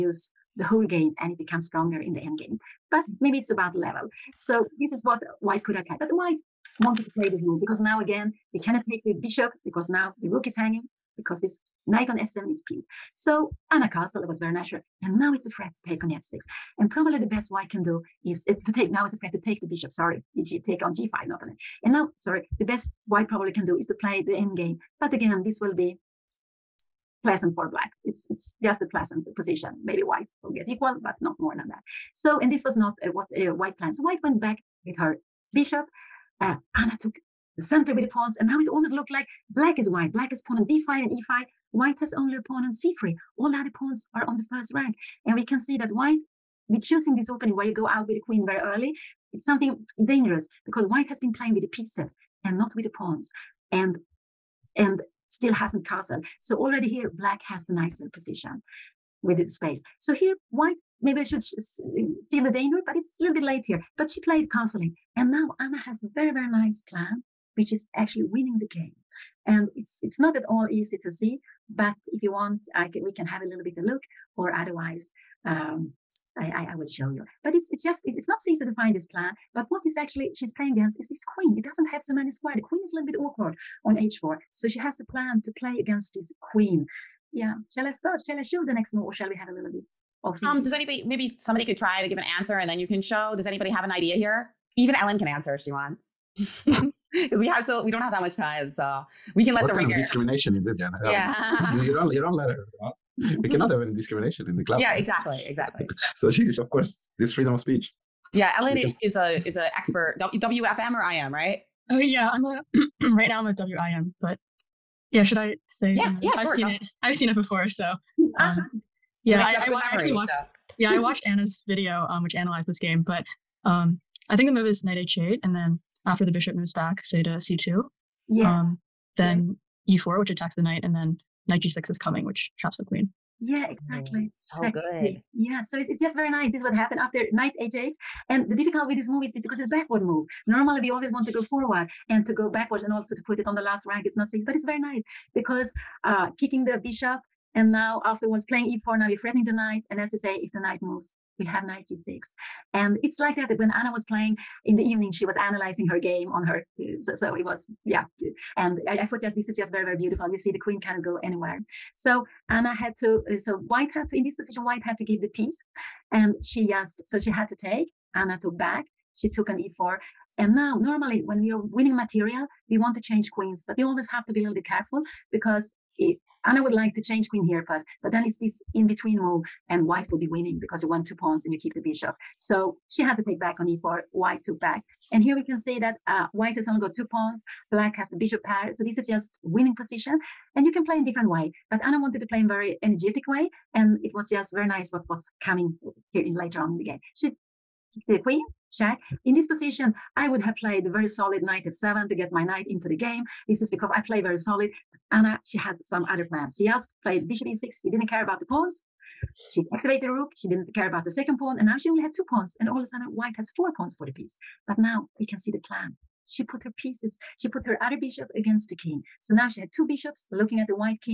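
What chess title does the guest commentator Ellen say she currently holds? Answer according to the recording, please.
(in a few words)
WIM.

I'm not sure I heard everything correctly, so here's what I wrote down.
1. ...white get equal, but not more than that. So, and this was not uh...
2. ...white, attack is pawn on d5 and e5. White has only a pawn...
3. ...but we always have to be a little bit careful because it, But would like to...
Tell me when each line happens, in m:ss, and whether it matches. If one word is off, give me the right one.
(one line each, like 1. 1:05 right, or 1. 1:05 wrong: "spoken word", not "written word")
1. 0:30 right
2. 0:39 wrong: "black", not "attack"
3. 2:53 wrong: "Anna", not "But".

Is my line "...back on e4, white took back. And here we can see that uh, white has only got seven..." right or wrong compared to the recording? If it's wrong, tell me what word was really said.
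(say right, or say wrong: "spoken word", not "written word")
wrong: "two", not "seven".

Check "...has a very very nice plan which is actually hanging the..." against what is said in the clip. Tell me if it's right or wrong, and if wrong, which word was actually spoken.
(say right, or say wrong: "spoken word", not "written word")
wrong: "winning", not "hanging".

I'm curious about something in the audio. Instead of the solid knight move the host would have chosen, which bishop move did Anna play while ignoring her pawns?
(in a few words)
Bishop e6.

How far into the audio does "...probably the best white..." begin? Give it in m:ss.
0:16.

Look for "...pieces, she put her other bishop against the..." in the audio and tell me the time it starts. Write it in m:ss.
3:36.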